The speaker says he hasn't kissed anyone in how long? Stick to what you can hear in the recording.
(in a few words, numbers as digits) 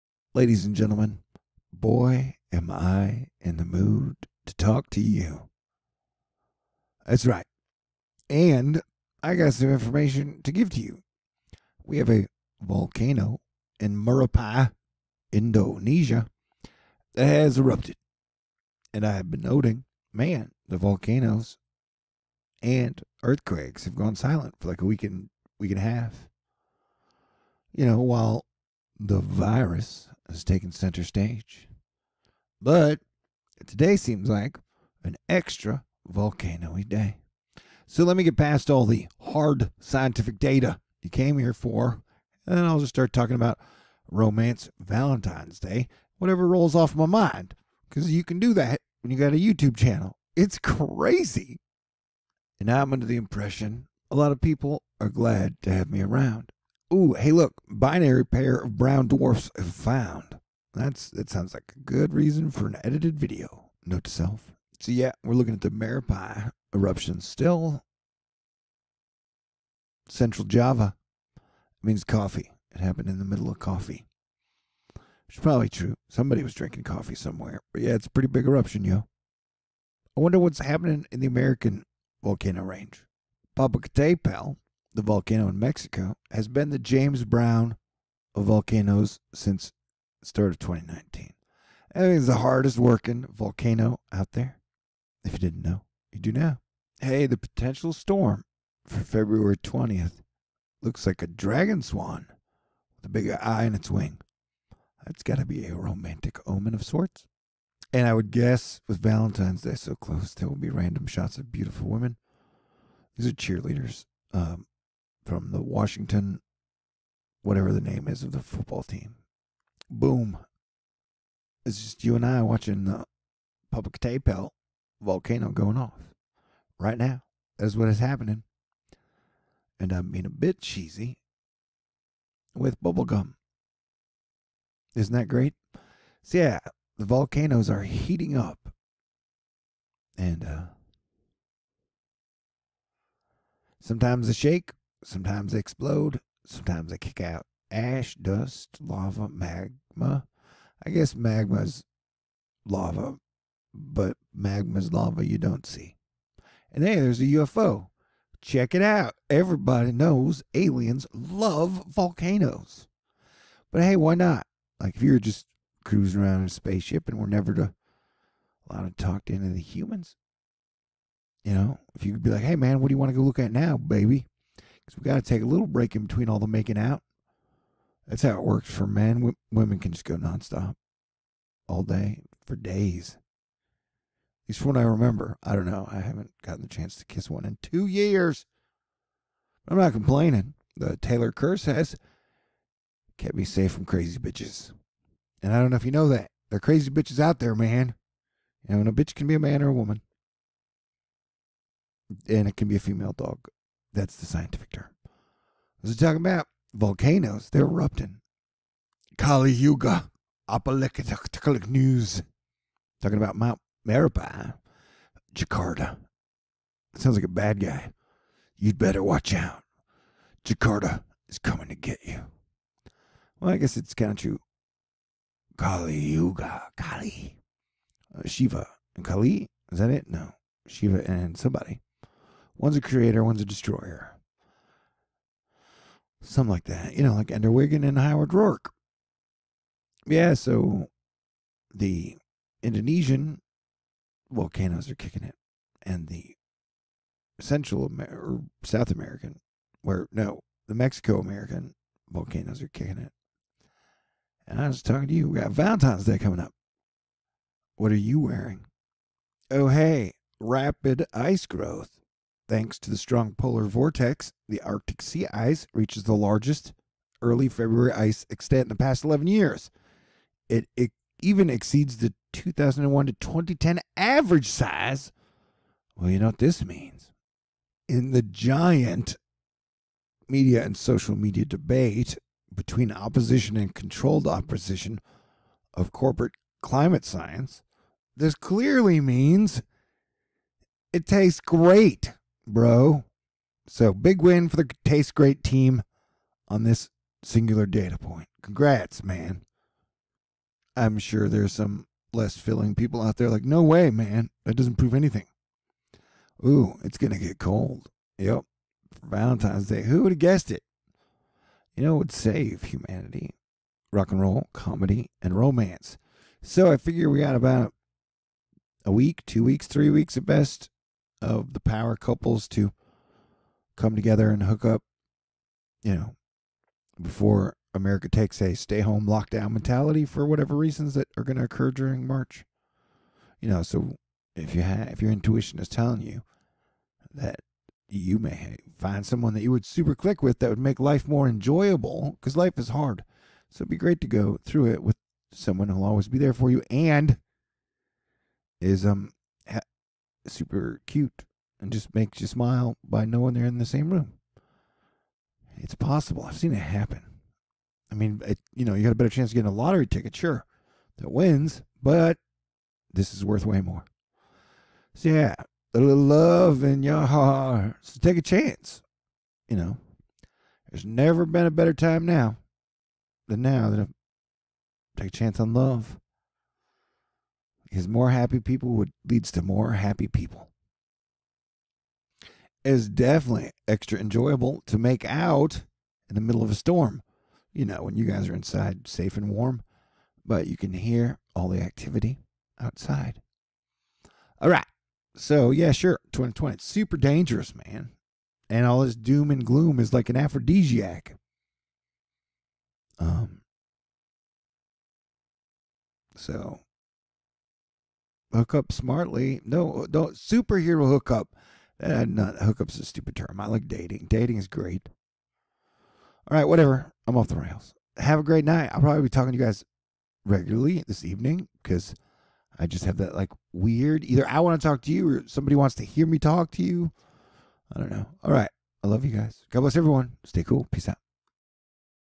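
2 years.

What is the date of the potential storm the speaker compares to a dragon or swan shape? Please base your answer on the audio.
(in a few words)
February 20.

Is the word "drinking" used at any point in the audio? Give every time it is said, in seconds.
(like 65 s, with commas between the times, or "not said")
76 s.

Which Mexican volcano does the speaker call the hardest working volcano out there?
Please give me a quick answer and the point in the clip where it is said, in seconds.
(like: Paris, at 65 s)
Popocatepetl, at 123 s.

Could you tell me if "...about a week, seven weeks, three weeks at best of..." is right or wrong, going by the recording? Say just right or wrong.
wrong.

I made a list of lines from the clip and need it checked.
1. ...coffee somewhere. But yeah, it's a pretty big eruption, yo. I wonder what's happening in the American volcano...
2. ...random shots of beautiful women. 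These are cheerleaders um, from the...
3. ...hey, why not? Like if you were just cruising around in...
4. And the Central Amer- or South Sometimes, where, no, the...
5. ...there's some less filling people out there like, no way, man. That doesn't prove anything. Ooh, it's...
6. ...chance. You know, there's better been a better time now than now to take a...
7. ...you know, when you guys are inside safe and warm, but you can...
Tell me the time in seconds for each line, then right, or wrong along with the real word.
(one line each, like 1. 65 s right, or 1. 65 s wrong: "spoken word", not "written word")
1. 76 s right
2. 110 s right
3. 163 s right
4. 245 s wrong: "American", not "Sometimes"
5. 301 s right
6. 368 s wrong: "never", not "better"
7. 387 s right.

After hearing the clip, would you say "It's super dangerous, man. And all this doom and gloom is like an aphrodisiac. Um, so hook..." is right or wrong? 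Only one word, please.
right.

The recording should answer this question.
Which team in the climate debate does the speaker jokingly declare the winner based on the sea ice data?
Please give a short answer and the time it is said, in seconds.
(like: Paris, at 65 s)
Taste Great team, at 294 s.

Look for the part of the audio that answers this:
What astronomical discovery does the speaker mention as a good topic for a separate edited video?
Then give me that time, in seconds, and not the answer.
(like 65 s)
57 s.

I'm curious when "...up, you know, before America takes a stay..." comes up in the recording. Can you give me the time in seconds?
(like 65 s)
324 s.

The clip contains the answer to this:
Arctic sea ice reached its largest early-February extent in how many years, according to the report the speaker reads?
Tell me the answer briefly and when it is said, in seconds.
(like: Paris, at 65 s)
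11 years, at 269 s.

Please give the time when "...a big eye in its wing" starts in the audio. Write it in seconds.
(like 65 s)
103 s.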